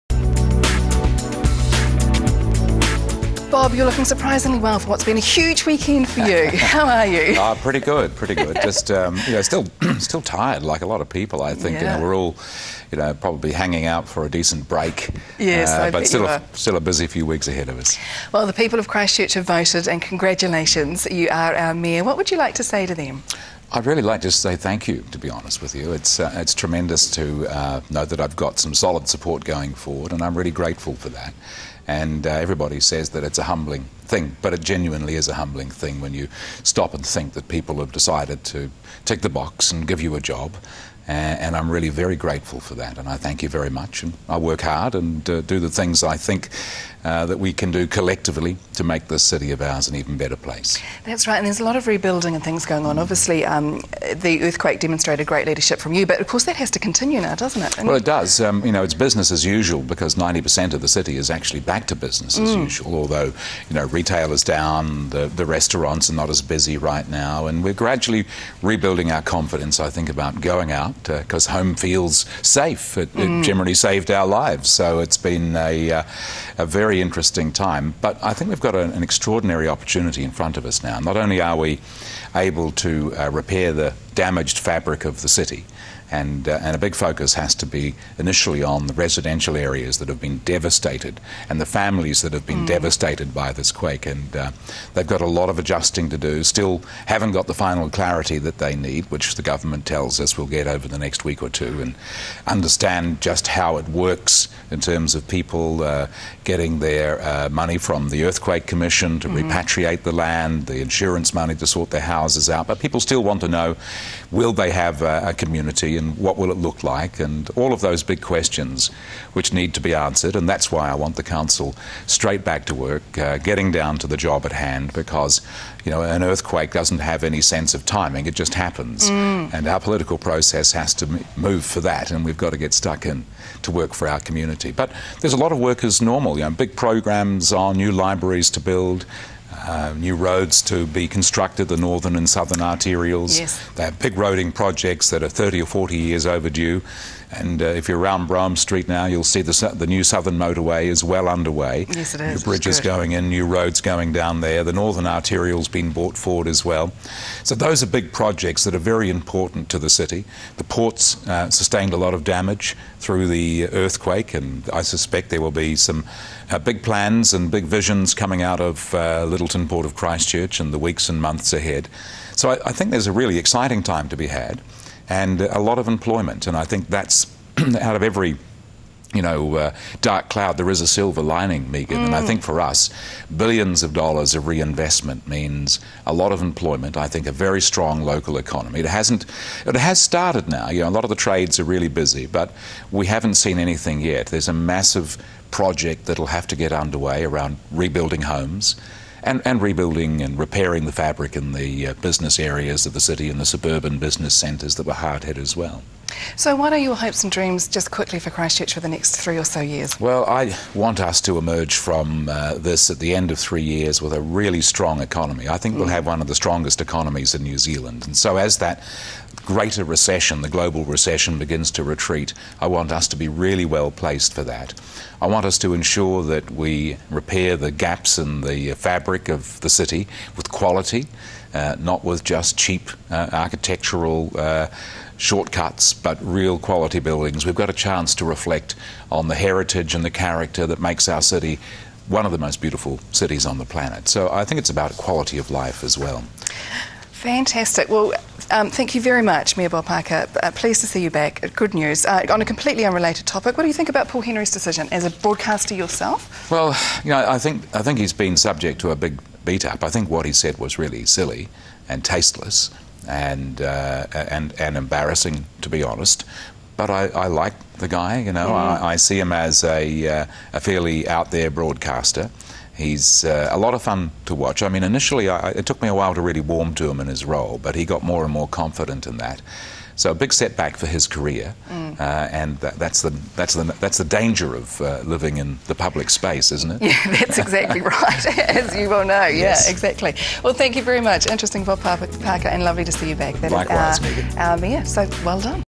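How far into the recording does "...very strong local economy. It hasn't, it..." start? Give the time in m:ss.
3:07.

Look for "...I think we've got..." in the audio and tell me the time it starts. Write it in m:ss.
1:18.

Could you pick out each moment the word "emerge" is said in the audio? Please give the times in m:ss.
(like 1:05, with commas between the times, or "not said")
3:31.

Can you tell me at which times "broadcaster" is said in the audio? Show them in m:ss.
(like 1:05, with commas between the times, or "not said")
4:15, 4:31.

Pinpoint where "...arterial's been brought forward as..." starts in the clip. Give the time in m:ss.
2:35.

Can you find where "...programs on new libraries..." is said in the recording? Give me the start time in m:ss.
2:16.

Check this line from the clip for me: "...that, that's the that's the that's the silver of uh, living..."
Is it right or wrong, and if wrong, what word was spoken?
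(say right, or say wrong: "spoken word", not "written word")
wrong: "danger", not "silver".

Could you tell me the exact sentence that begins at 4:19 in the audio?
I think what he said was really silly and tasteless and, uh, and, and embarrassing, to be honest.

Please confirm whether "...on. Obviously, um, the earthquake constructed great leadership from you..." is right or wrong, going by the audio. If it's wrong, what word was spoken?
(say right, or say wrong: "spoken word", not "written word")
wrong: "demonstrated", not "constructed".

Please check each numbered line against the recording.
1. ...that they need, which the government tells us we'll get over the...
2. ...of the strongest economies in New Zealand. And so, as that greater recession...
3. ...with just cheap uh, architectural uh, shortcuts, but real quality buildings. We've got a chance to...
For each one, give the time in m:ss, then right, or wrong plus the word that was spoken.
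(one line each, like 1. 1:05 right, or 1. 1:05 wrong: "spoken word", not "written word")
1. 1:38 right
2. 3:36 right
3. 3:52 right.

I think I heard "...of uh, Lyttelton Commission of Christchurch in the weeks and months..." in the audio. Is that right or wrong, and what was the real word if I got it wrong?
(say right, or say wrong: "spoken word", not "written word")
wrong: "Port", not "Commission".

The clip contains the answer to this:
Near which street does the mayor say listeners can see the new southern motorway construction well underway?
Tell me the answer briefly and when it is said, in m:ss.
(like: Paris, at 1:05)
Brougham Street, at 2:28.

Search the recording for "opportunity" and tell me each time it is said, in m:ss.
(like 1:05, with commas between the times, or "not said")
1:19.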